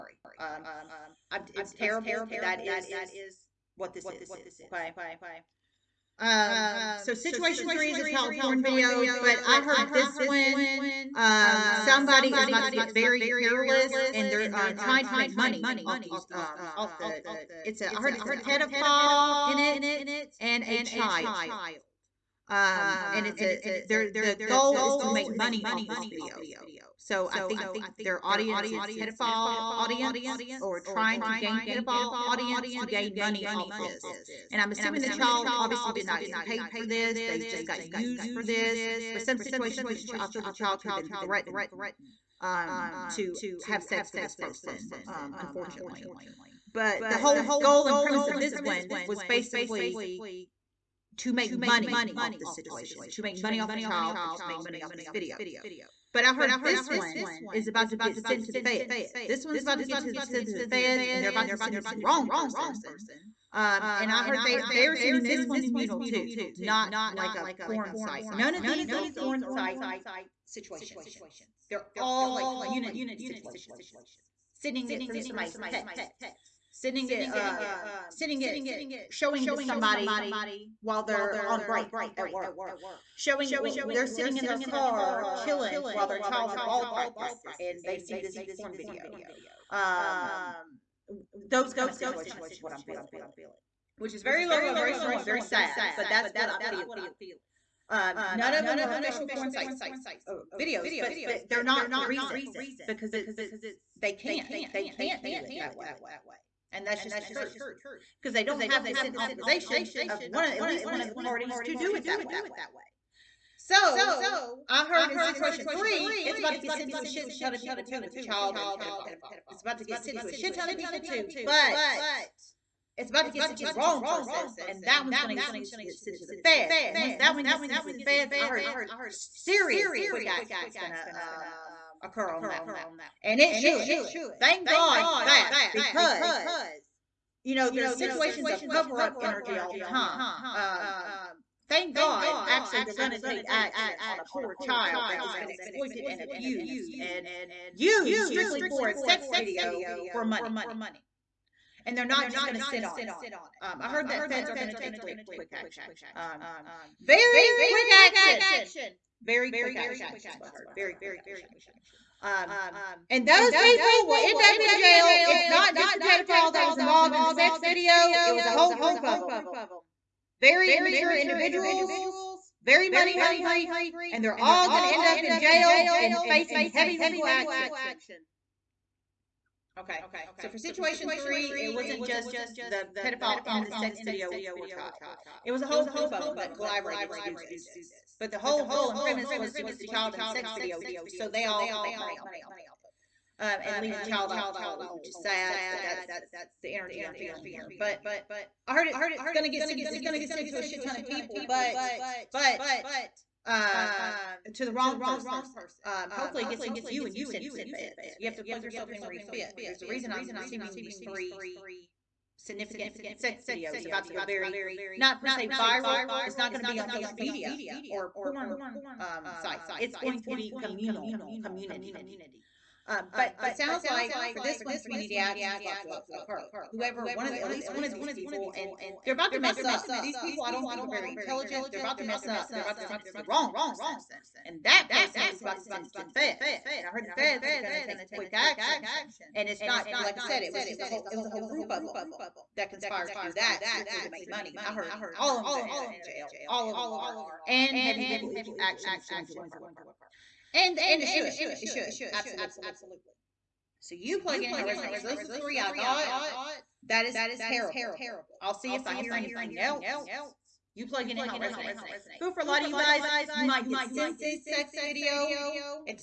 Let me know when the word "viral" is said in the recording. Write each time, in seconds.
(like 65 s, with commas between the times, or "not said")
215 s.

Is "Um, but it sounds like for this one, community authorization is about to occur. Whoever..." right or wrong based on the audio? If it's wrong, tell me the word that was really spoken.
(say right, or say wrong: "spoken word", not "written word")
wrong: "action", not "authorization".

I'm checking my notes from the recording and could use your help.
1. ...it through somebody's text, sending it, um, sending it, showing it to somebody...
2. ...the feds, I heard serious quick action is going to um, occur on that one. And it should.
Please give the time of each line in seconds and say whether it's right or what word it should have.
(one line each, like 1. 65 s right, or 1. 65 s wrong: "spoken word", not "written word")
1. 74 s right
2. 127 s right.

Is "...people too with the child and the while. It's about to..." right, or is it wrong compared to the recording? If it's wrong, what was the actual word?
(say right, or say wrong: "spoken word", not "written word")
wrong: "pedophile", not "while".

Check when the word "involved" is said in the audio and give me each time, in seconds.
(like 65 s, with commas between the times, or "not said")
166 s.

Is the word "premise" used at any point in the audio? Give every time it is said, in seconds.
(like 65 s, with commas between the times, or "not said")
47 s, 188 s.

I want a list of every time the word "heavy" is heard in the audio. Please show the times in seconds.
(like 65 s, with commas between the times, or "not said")
176 s, 247 s.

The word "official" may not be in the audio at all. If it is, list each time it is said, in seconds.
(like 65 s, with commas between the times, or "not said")
98 s.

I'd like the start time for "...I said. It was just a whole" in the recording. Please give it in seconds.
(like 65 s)
240 s.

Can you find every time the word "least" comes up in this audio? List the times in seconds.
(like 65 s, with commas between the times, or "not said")
110 s, 227 s.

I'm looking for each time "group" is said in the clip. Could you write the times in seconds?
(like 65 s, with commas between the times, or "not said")
168 s, 185 s, 241 s.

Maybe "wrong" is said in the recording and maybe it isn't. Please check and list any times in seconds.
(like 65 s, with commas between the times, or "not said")
62 s, 123 s, 204 s, 233 s.